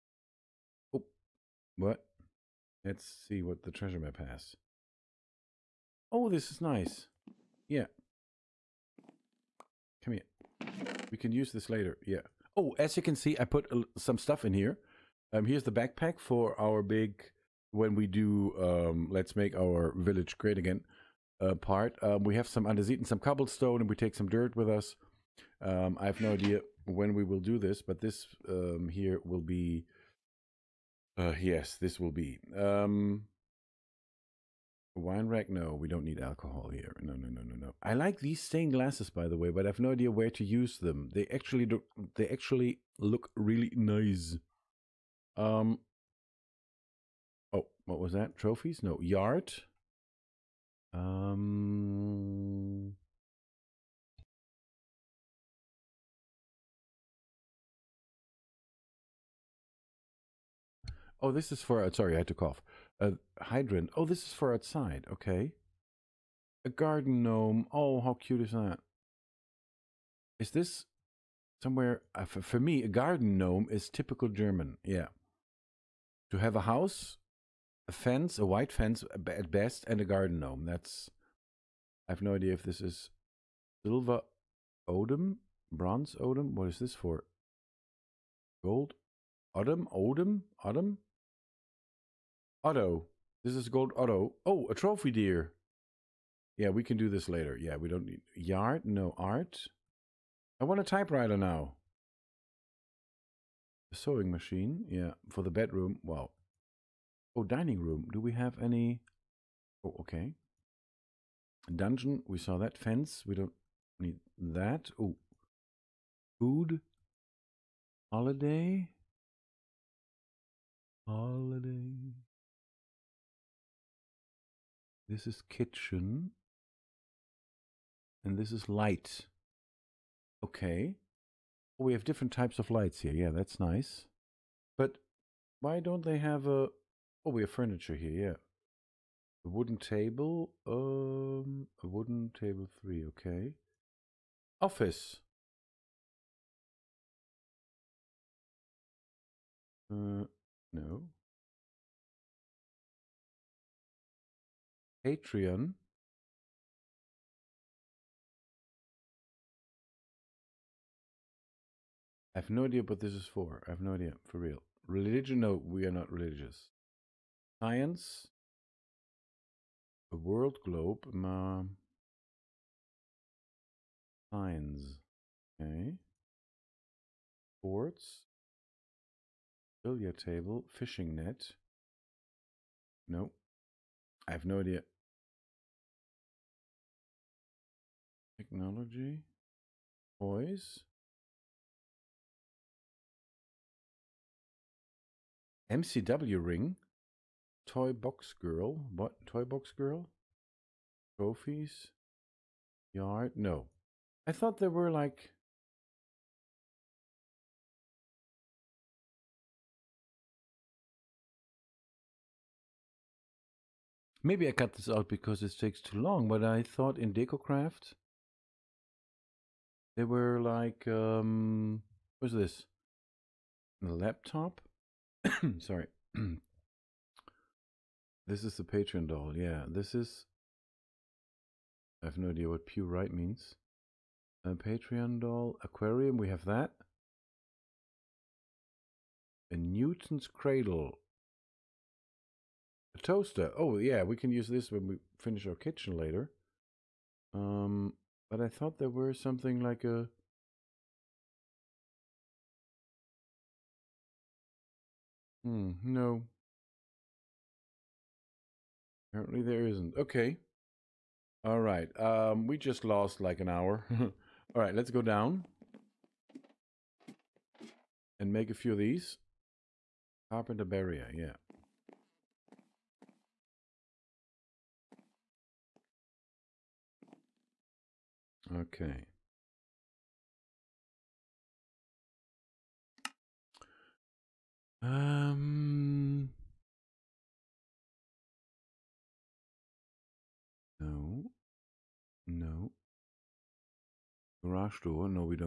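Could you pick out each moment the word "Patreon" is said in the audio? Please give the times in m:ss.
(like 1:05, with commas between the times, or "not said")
2:35, 3:48, 3:54.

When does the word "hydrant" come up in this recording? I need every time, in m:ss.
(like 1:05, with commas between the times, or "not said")
1:03.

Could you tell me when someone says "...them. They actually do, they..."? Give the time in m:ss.
0:40.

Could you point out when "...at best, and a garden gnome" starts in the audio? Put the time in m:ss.
1:19.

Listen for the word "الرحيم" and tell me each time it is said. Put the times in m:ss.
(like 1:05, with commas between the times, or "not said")
not said.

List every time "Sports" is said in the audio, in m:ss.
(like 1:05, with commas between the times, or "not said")
2:57.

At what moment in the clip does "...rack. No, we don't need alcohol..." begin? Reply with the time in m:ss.
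0:35.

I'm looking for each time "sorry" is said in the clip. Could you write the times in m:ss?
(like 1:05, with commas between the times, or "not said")
1:01, 3:45.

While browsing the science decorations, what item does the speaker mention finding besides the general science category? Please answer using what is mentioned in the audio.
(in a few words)
A world globe.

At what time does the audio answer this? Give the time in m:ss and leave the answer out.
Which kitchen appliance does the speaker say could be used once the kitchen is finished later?
4:02.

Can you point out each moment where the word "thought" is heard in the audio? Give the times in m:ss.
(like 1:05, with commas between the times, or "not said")
3:24, 3:36, 4:08.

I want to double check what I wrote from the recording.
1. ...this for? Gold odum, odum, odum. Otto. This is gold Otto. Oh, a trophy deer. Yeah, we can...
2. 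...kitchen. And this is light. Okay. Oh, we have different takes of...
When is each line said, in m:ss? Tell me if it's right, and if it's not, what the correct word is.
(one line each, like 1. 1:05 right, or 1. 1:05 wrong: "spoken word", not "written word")
1. 1:26 right
2. 2:05 wrong: "types", not "takes".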